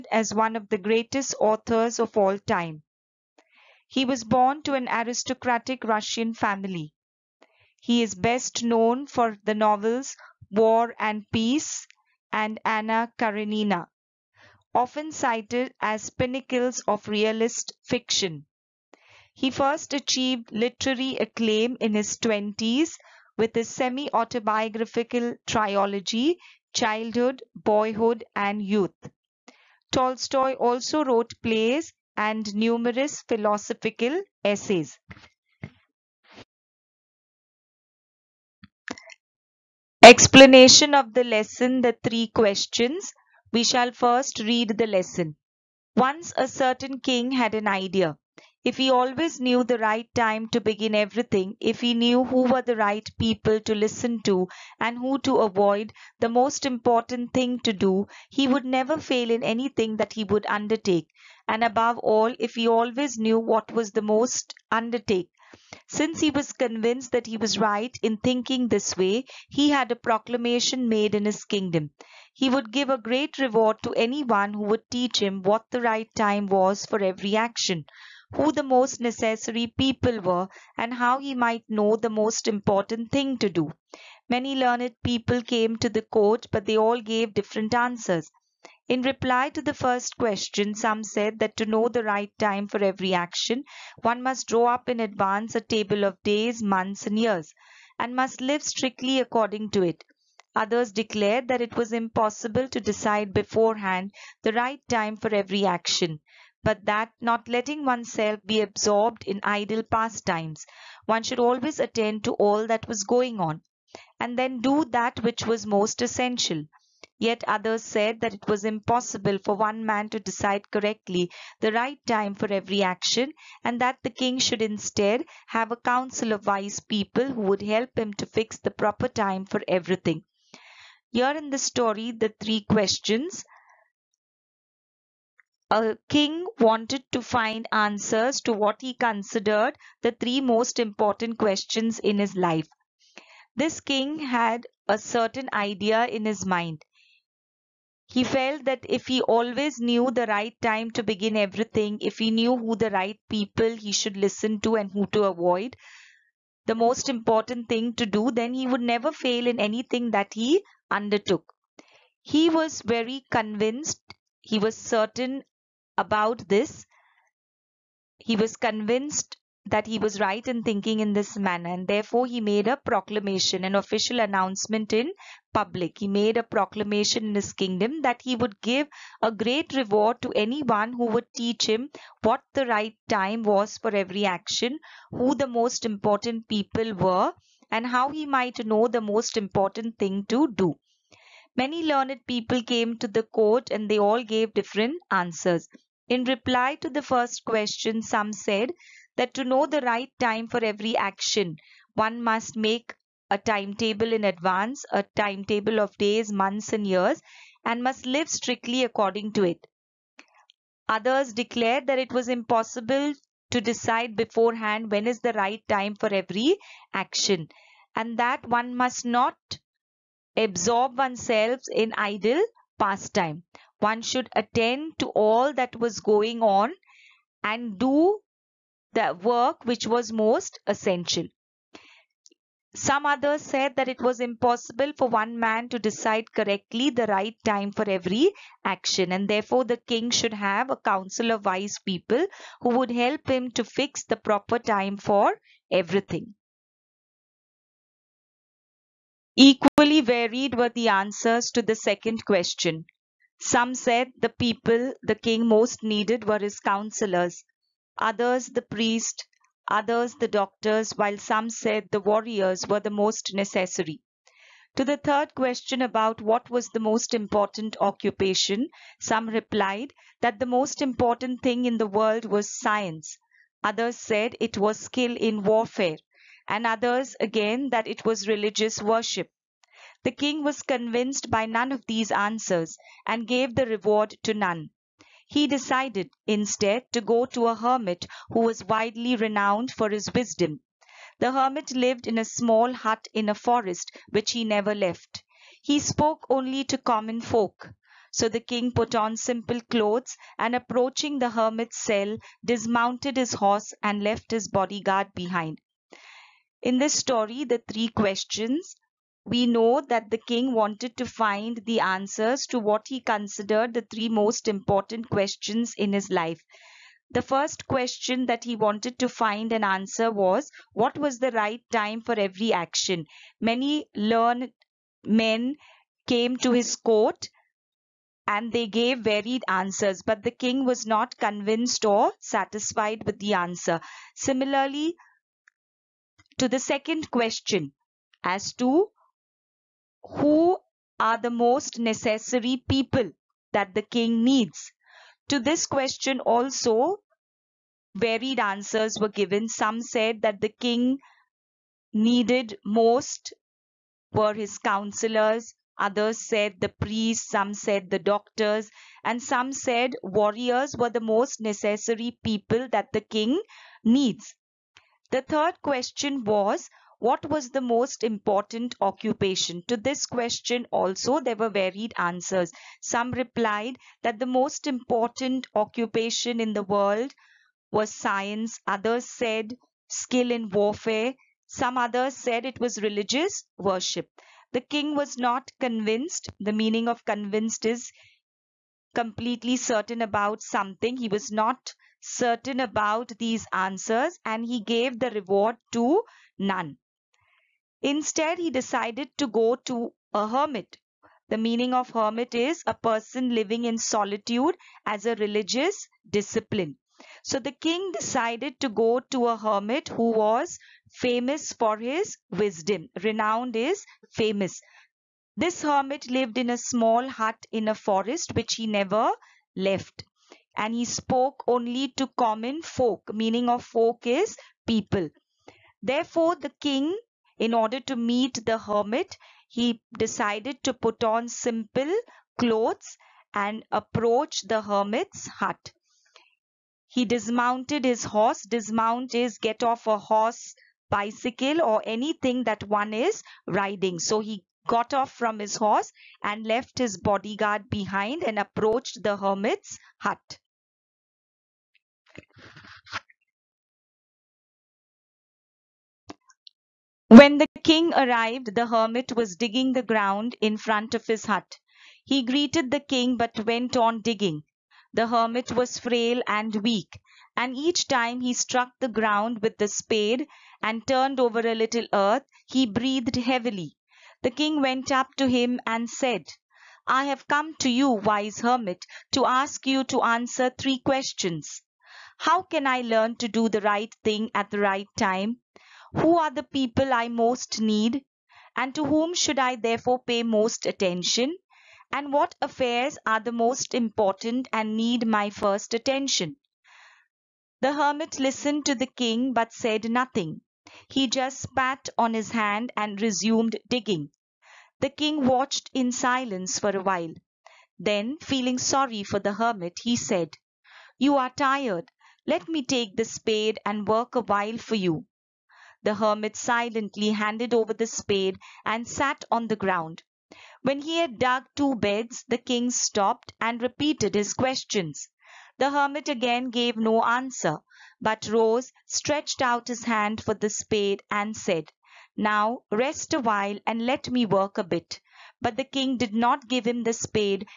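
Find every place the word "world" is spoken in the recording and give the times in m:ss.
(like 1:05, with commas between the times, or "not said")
4:31, 6:16.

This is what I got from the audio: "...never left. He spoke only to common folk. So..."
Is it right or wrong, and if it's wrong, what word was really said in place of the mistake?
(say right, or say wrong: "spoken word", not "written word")
right.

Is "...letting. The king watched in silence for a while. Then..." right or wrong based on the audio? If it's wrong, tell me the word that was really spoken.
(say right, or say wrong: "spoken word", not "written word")
wrong: "digging", not "letting".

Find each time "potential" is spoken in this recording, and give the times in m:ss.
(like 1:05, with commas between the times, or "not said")
not said.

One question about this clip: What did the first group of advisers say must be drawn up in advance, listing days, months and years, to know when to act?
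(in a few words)
A table.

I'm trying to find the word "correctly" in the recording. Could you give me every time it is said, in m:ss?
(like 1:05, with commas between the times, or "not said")
2:00, 3:56.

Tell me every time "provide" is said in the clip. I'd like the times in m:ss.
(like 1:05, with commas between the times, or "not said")
not said.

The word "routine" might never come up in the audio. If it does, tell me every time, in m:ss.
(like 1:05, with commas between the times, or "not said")
not said.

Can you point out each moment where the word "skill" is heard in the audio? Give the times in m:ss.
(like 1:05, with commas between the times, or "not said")
4:34, 6:19.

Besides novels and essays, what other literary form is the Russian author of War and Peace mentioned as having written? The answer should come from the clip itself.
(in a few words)
Plays.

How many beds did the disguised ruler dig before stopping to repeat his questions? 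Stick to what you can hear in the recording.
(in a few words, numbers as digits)
2.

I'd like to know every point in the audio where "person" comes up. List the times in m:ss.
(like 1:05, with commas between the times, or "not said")
6:42.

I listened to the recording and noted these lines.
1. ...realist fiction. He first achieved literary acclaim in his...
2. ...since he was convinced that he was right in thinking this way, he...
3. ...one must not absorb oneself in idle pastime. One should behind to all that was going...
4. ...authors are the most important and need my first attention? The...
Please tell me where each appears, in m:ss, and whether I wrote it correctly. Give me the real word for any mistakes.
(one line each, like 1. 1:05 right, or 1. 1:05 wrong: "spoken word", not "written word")
1. 0:17 right
2. 1:05 right
3. 3:38 wrong: "attend", not "behind"
4. 8:12 wrong: "affairs", not "authors".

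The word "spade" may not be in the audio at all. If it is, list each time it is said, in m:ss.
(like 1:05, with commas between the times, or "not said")
7:49, 8:33, 8:37, 8:50, 8:56.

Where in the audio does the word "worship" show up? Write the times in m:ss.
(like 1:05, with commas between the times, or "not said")
4:38, 6:23.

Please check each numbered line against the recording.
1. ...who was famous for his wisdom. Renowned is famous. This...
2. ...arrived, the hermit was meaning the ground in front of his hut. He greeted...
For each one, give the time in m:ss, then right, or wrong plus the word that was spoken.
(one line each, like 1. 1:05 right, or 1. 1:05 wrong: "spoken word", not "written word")
1. 6:49 right
2. 7:37 wrong: "digging", not "meaning".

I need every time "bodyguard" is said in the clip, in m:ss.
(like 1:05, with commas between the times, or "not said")
5:04, 7:26.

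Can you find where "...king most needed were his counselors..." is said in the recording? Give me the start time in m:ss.
4:15.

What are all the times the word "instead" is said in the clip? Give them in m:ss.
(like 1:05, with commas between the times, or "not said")
2:04, 4:46, 6:37.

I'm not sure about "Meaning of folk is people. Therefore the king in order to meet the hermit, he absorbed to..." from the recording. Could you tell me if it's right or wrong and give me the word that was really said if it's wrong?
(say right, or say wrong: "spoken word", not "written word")
wrong: "decided", not "absorbed".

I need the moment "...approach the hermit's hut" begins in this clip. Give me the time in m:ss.
7:13.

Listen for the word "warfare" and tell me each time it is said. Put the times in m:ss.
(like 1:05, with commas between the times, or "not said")
4:35, 6:20.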